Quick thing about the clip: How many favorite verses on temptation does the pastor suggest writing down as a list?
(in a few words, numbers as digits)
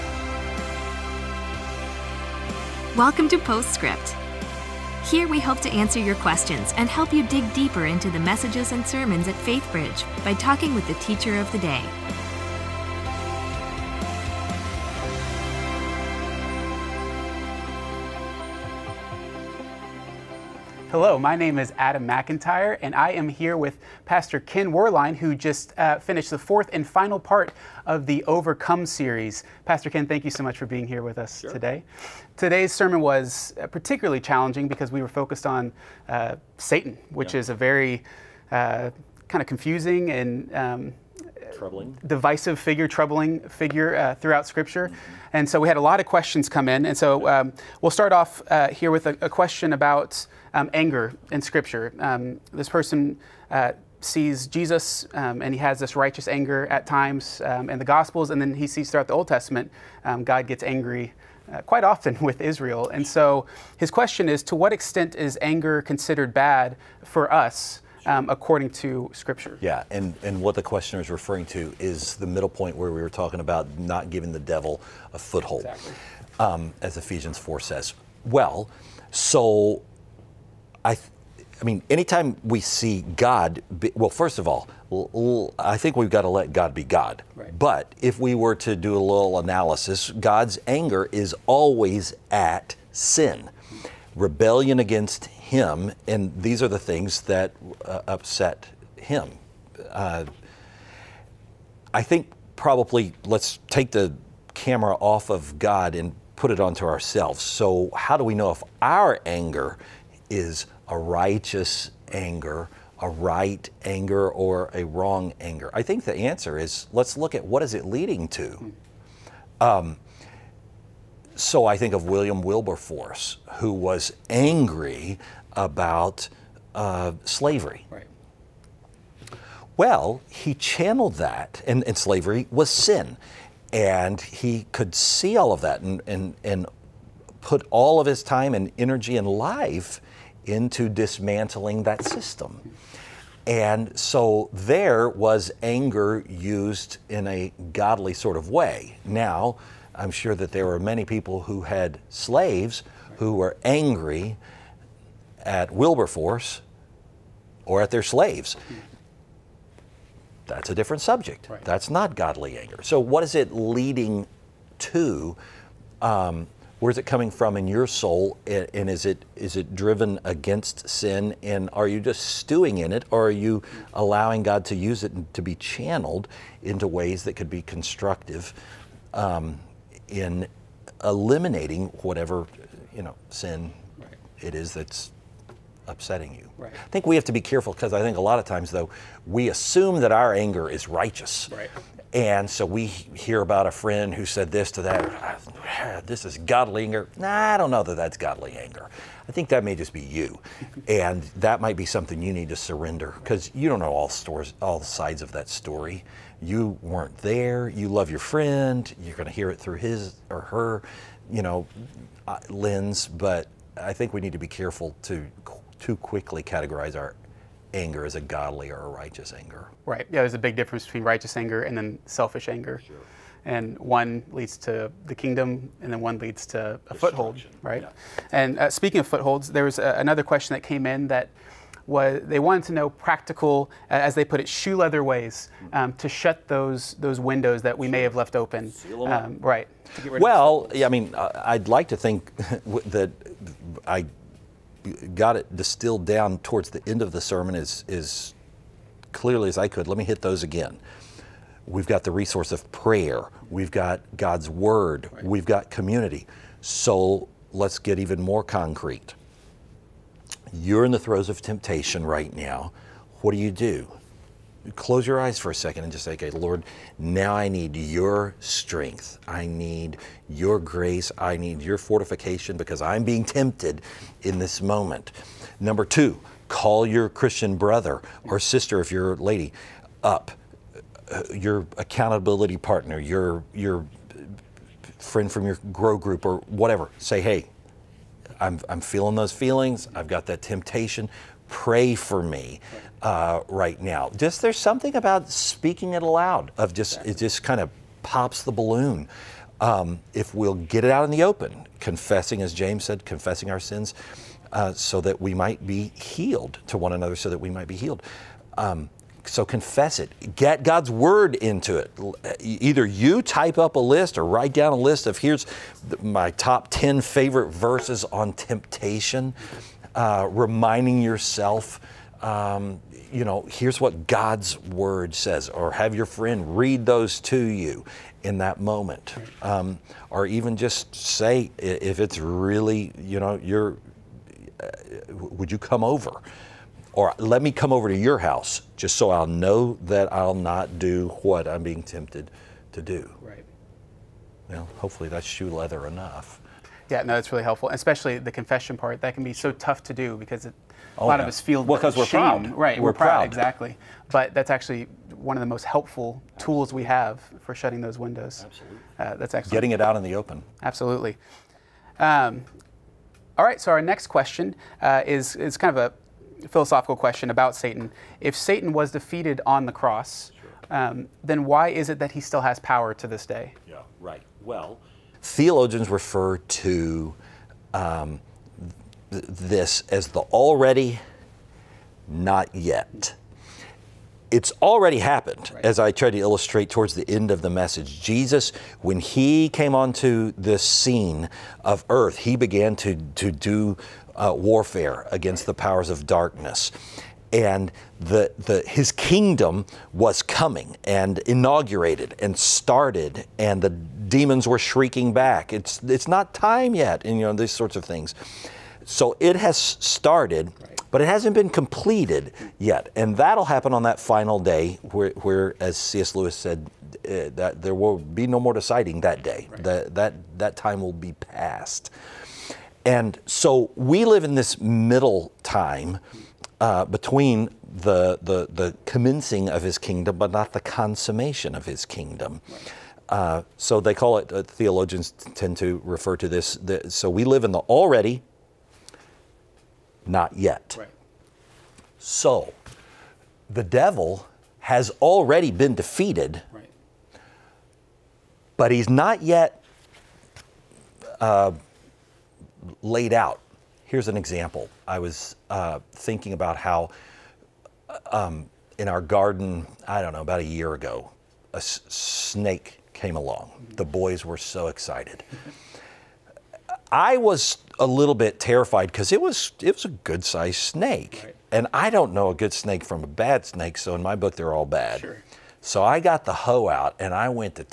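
10.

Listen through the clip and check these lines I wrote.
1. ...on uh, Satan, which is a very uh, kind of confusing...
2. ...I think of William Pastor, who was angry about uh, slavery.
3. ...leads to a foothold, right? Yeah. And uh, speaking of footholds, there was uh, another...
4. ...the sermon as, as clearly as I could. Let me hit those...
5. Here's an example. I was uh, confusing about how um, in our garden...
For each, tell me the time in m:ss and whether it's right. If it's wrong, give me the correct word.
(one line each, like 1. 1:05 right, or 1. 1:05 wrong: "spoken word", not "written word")
1. 0:35 right
2. 2:01 wrong: "Wilberforce", not "Pastor"
3. 3:46 right
4. 4:07 right
5. 7:33 wrong: "thinking", not "confusing".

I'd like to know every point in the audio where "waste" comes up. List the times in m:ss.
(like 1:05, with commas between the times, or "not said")
not said.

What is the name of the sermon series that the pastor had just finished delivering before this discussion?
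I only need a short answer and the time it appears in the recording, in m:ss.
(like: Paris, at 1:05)
Overcome, at 0:28.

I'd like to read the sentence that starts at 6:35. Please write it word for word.
the powers of darkness and the, the, his kingdom was coming and inaugurated and started, and the demons were shrieking back.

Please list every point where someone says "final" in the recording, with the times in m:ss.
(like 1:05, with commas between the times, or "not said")
0:26, 6:53.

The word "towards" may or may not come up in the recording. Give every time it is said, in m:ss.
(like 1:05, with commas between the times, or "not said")
4:06, 6:26.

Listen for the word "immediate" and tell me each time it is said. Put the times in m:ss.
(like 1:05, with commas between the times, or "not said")
not said.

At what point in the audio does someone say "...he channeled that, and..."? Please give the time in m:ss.
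2:10.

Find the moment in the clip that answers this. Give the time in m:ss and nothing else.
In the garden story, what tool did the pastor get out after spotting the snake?
7:56.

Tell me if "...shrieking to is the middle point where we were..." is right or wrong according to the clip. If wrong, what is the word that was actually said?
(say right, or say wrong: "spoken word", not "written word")
wrong: "referring", not "shrieking".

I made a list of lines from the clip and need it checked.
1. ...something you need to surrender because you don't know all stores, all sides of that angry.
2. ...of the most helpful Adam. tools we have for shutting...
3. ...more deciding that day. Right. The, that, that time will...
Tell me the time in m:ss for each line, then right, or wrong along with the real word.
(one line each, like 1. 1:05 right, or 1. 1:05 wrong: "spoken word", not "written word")
1. 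3:21 wrong: "story", not "angry"
2. 5:55 wrong: "Absolutely", not "Adam"
3. 6:58 right.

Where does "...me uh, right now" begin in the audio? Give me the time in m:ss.
4:52.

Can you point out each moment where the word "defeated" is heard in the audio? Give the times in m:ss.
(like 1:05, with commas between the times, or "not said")
6:08, 7:25.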